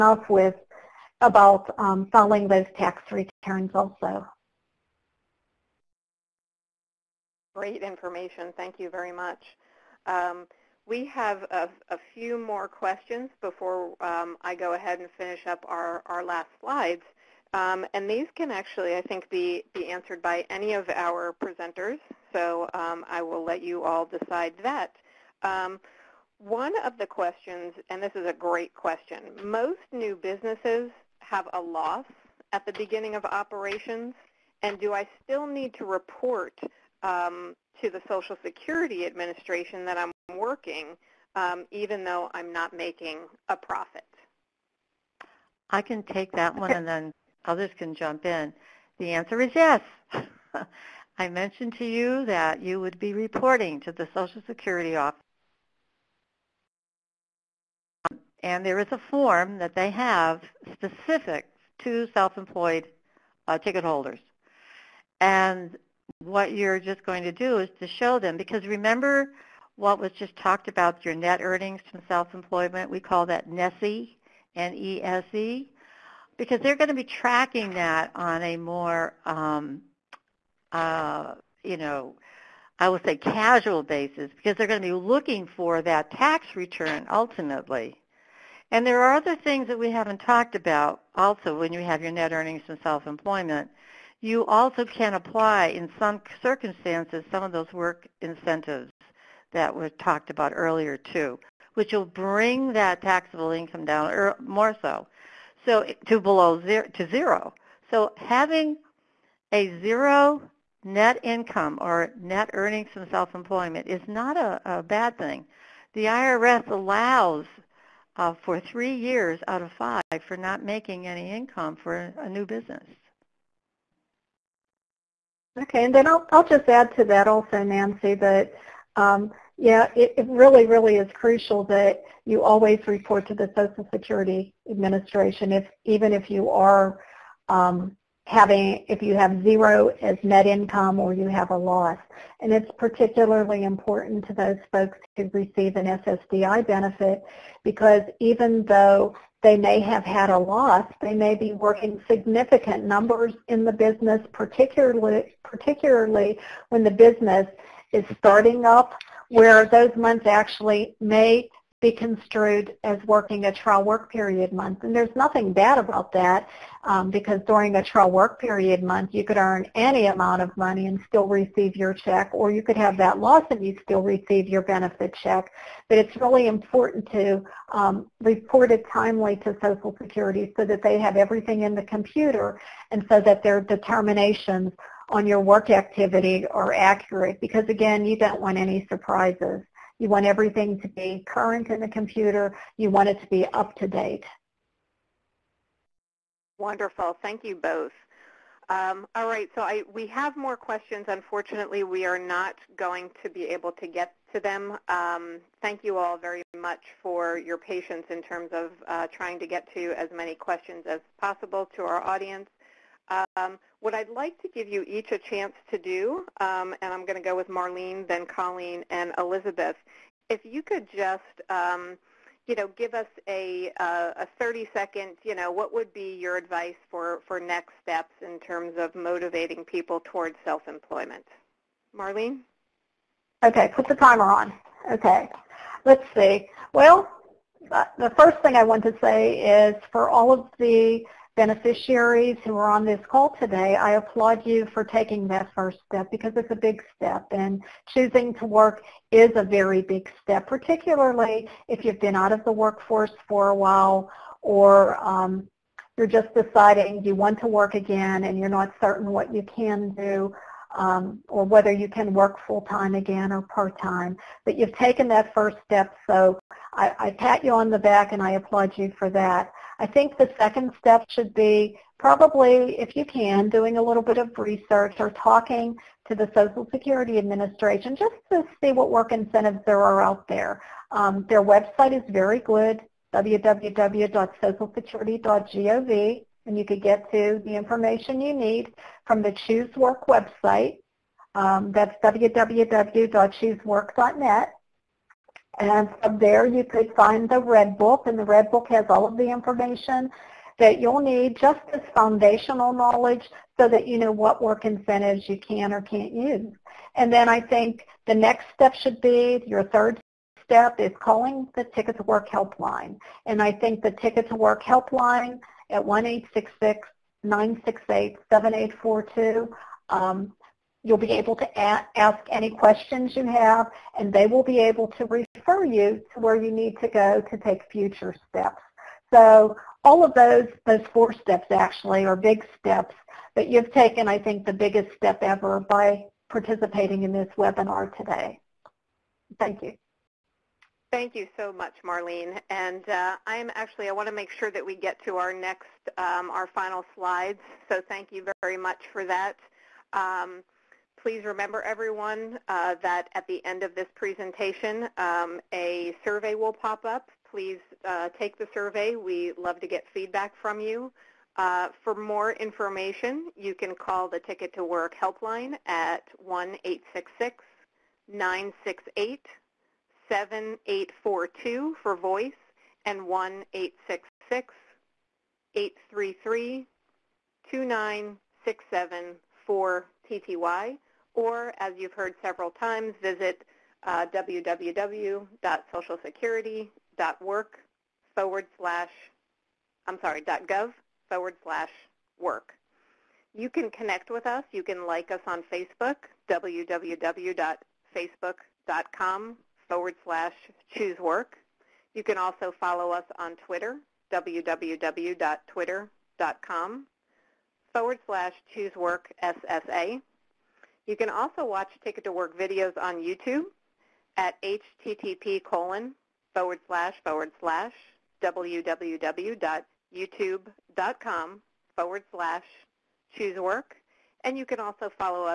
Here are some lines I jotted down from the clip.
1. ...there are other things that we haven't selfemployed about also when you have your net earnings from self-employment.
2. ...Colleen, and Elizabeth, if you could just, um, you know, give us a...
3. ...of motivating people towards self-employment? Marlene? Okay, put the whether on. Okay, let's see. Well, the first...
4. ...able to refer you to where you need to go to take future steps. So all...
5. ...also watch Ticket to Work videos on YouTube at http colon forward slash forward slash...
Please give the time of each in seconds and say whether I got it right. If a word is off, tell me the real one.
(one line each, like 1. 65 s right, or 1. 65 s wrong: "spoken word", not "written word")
1. 88 s wrong: "talked", not "selfemployed"
2. 218 s right
3. 228 s wrong: "timer", not "whether"
4. 324 s right
5. 411 s right.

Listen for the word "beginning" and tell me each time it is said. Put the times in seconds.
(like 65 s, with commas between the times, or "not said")
32 s.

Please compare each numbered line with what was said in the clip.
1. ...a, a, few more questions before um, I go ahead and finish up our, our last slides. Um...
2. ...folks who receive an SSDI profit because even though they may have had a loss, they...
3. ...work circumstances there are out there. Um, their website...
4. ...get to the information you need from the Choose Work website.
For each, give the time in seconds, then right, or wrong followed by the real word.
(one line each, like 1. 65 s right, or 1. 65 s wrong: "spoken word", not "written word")
1. 11 s right
2. 144 s wrong: "benefit", not "profit"
3. 278 s wrong: "incentives", not "circumstances"
4. 286 s right.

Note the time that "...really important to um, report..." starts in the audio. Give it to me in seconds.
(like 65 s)
176 s.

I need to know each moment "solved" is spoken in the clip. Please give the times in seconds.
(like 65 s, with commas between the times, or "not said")
not said.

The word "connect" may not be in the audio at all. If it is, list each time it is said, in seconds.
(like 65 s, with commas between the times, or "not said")
393 s.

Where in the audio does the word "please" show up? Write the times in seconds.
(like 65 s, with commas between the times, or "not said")
351 s, 357 s.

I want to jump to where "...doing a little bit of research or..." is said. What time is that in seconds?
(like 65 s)
273 s.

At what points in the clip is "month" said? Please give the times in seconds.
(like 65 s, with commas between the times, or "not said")
159 s, 164 s, 168 s.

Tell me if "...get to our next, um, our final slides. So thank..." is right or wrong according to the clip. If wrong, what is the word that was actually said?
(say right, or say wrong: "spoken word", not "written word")
right.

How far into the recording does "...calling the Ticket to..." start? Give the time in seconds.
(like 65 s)
310 s.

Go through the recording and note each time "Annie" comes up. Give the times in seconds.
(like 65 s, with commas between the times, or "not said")
not said.